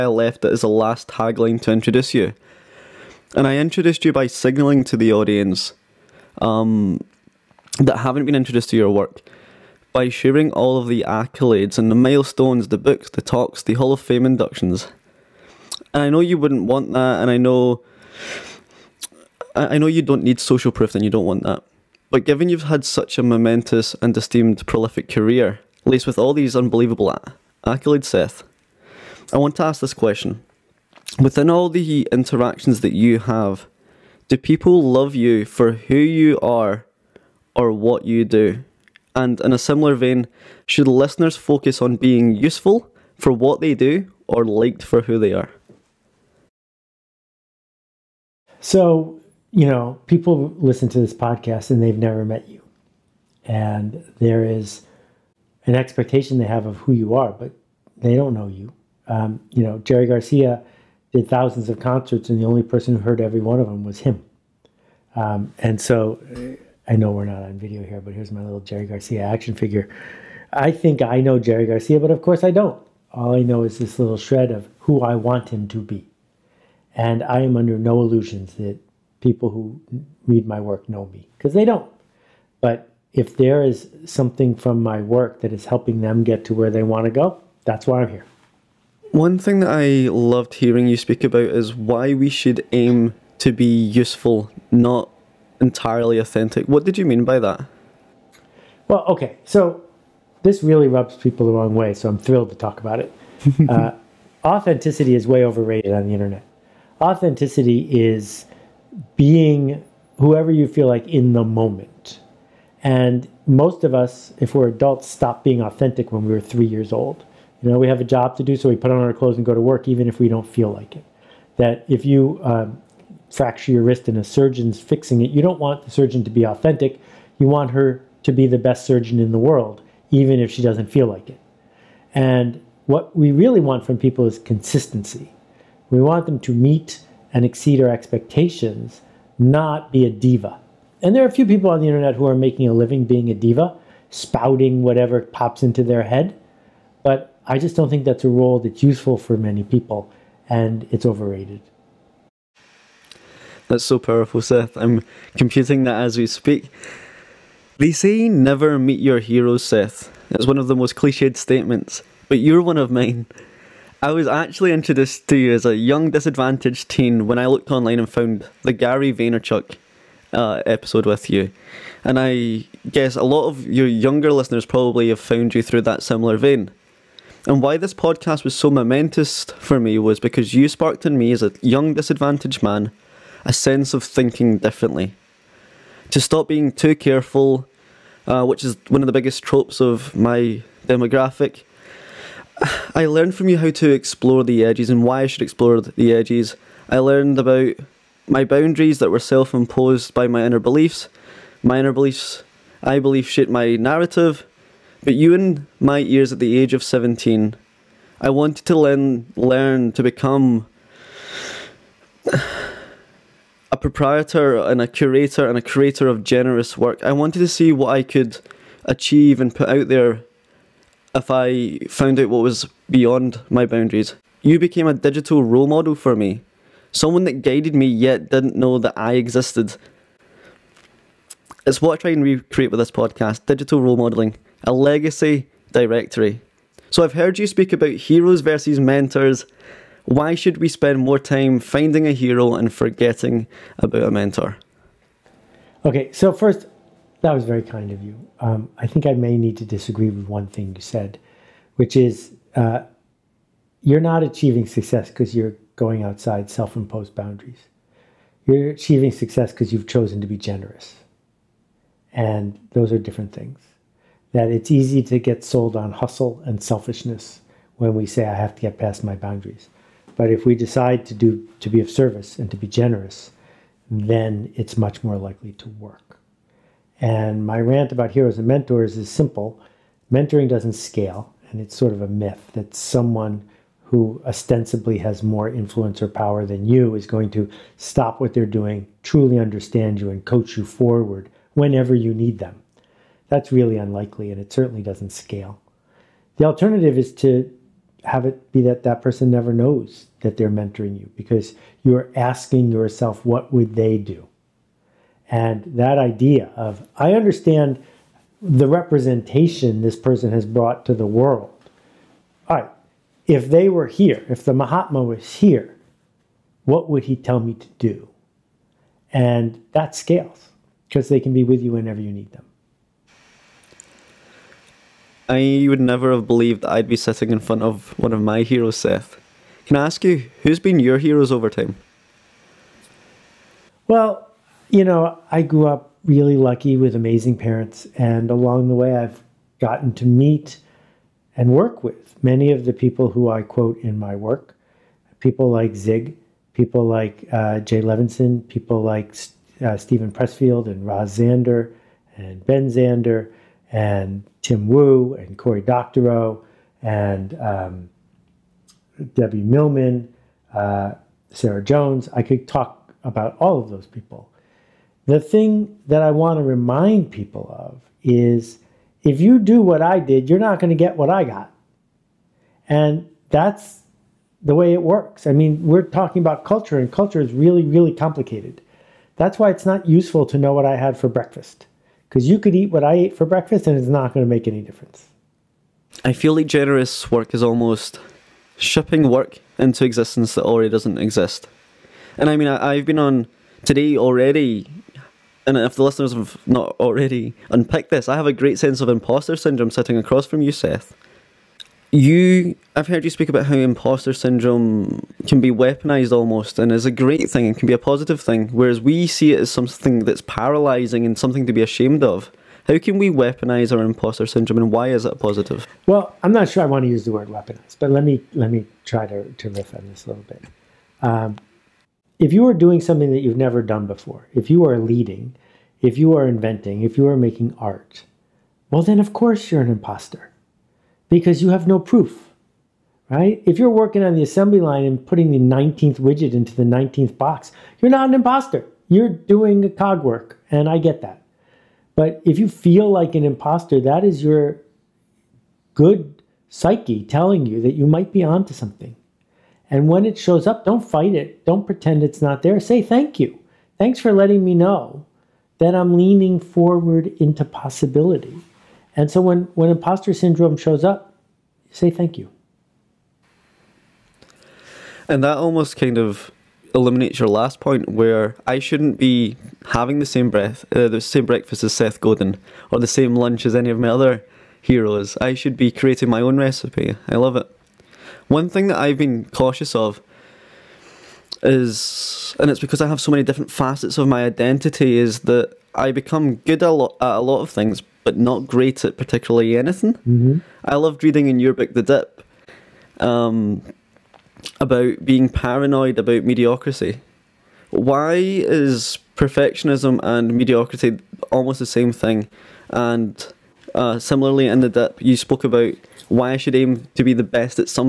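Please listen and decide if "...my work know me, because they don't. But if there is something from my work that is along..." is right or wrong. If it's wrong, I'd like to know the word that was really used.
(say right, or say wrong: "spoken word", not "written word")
wrong: "helping", not "along".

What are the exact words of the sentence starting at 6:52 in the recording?
How can we weaponize our imposter syndrome and why is it positive?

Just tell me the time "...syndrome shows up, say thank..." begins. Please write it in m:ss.
7:40.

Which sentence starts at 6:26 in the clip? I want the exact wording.
I feel like generous work is almost shipping work into existence that already doesn't exist.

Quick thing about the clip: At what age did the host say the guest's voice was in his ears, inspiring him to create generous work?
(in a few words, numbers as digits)
17.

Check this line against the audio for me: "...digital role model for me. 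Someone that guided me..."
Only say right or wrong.
right.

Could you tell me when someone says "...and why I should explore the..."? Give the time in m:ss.
3:14.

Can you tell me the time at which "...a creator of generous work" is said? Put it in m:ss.
3:35.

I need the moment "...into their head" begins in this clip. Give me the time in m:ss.
2:25.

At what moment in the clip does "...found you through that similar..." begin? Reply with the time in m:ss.
2:55.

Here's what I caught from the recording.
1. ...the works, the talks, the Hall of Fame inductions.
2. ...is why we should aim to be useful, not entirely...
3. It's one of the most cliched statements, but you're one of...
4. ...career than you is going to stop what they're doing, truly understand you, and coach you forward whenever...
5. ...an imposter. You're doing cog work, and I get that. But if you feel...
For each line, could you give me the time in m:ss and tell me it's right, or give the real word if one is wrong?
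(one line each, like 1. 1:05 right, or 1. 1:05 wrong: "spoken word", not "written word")
1. 0:12 wrong: "books", not "works"
2. 1:31 right
3. 2:40 right
4. 4:46 wrong: "power", not "career"
5. 7:18 right.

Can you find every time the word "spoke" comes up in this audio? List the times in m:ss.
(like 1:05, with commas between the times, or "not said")
8:25.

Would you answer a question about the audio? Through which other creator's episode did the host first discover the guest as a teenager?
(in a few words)
Gary Vaynerchuk.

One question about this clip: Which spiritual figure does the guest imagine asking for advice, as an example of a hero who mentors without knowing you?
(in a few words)
the Mahatma.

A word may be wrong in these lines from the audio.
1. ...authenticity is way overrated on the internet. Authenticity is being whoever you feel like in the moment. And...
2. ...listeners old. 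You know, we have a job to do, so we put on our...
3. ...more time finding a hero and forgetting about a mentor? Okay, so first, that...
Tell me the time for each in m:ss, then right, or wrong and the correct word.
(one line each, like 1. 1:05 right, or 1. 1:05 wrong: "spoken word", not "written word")
1. 1:44 right
2. 1:56 wrong: "years", not "listeners"
3. 4:00 right.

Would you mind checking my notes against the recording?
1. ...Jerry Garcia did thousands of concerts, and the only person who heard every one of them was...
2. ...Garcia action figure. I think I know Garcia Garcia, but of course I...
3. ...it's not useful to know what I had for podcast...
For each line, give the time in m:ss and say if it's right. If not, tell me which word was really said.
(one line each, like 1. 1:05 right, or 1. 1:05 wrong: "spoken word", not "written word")
1. 0:59 right
2. 1:08 wrong: "Jerry", not "Garcia"
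3. 6:19 wrong: "breakfast", not "podcast".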